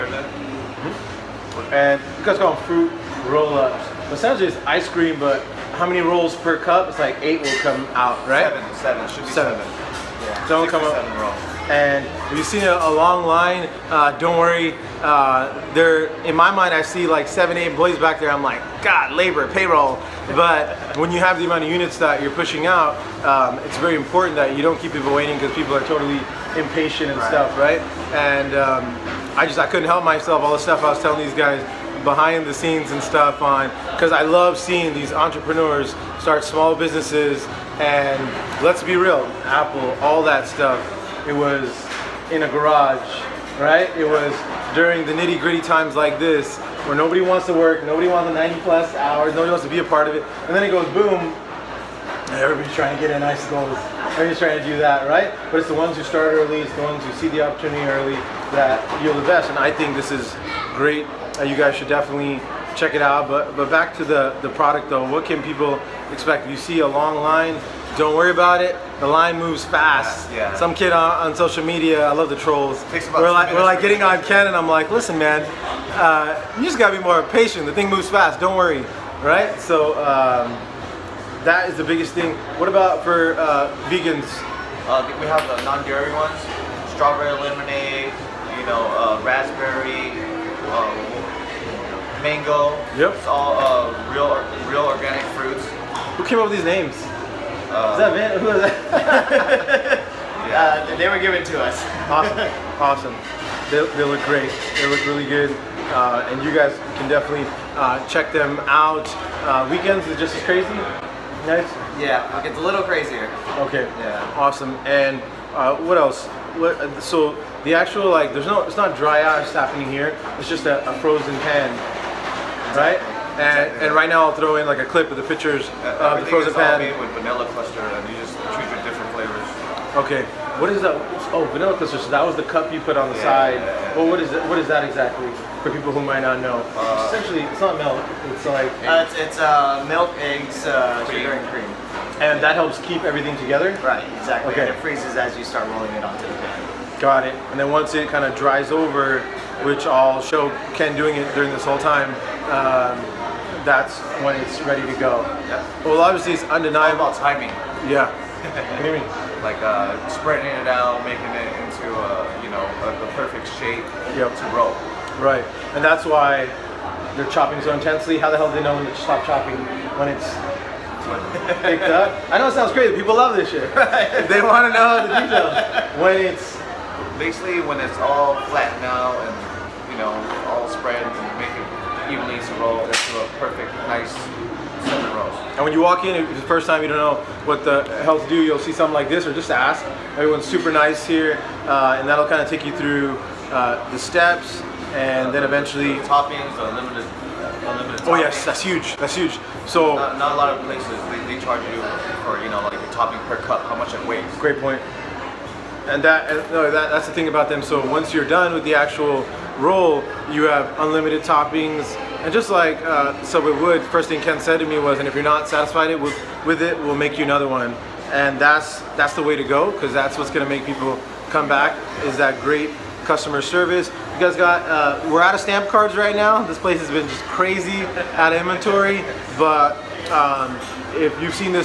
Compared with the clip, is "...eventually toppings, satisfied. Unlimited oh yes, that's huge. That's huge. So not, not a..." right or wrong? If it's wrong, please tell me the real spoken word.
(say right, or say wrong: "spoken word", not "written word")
wrong: "unlimited", not "satisfied".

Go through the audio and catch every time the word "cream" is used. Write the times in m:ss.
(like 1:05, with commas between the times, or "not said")
0:04, 2:21.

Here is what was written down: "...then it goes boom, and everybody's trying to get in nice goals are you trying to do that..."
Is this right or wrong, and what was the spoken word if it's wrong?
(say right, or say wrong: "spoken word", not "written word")
right.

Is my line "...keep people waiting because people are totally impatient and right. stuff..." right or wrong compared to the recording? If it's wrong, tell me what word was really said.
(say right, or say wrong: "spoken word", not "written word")
right.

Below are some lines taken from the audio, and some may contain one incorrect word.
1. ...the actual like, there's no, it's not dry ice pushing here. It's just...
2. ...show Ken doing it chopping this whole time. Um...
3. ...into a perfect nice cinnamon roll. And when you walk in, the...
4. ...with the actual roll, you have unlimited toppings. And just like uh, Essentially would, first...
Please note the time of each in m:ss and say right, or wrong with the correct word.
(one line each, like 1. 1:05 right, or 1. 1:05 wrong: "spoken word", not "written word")
1. 1:57 wrong: "happening", not "pushing"
2. 2:30 wrong: "during", not "chopping"
3. 3:02 right
4. 3:28 wrong: "Subway", not "Essentially".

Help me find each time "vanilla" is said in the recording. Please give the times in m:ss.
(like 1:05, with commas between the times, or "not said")
2:07, 2:11.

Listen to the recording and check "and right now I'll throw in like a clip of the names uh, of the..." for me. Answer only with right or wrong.
wrong.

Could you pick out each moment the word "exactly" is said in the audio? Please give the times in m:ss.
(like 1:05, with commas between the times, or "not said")
2:03, 2:14, 2:24.